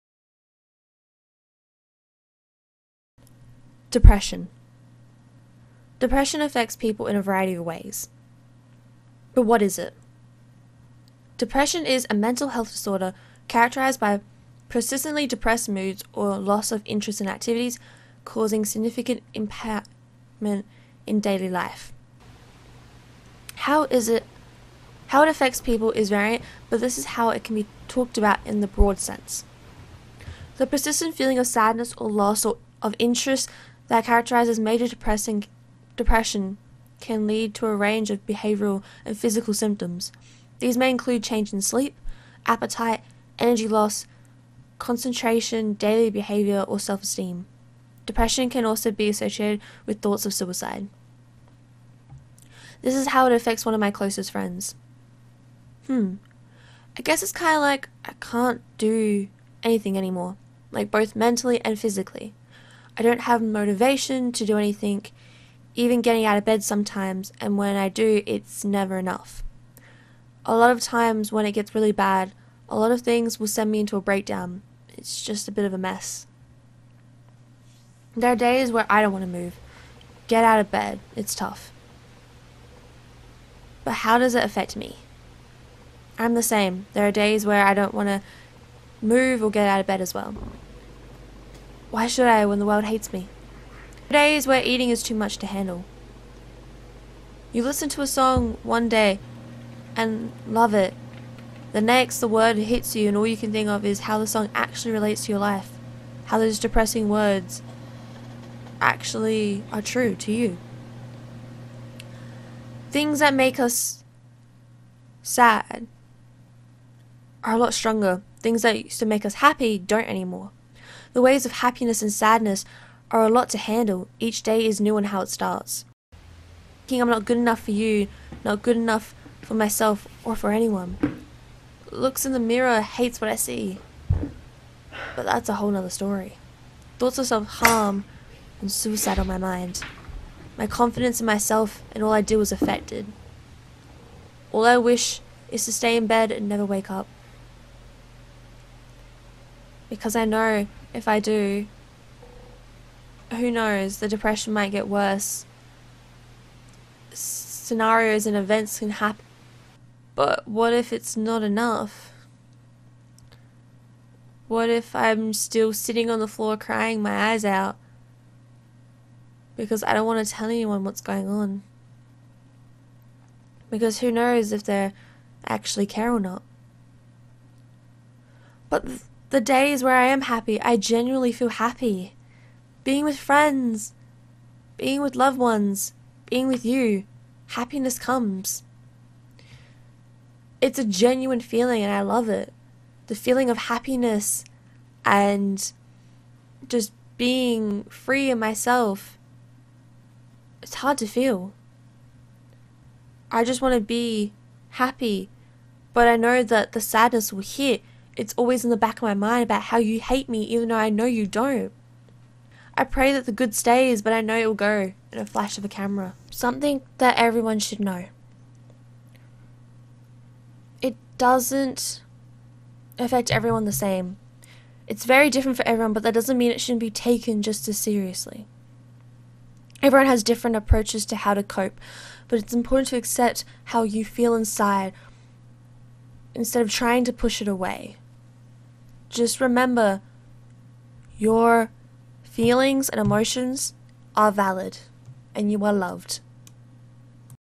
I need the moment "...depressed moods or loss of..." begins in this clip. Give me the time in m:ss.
0:15.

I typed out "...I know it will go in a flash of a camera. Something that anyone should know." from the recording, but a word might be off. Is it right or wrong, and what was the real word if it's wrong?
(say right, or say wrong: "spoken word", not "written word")
wrong: "everyone", not "anyone".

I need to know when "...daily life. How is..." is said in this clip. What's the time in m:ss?
0:21.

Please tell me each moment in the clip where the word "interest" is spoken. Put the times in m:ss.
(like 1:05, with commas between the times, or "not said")
0:16, 0:32.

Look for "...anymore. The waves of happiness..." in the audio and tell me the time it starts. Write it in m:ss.
2:00.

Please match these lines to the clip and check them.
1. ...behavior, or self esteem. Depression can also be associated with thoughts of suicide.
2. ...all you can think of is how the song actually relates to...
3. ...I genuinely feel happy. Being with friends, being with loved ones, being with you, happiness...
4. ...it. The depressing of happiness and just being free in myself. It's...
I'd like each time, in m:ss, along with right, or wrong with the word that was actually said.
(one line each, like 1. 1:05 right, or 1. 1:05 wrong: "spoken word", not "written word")
1. 0:46 right
2. 1:43 right
3. 3:00 right
4. 3:12 wrong: "feeling", not "depressing".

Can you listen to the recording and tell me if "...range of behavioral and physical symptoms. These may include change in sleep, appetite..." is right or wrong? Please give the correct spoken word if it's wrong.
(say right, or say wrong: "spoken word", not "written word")
right.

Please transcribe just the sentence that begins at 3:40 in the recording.
It doesn't affect everyone the same.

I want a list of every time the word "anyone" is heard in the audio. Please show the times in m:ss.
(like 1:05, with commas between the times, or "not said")
2:10, 2:50.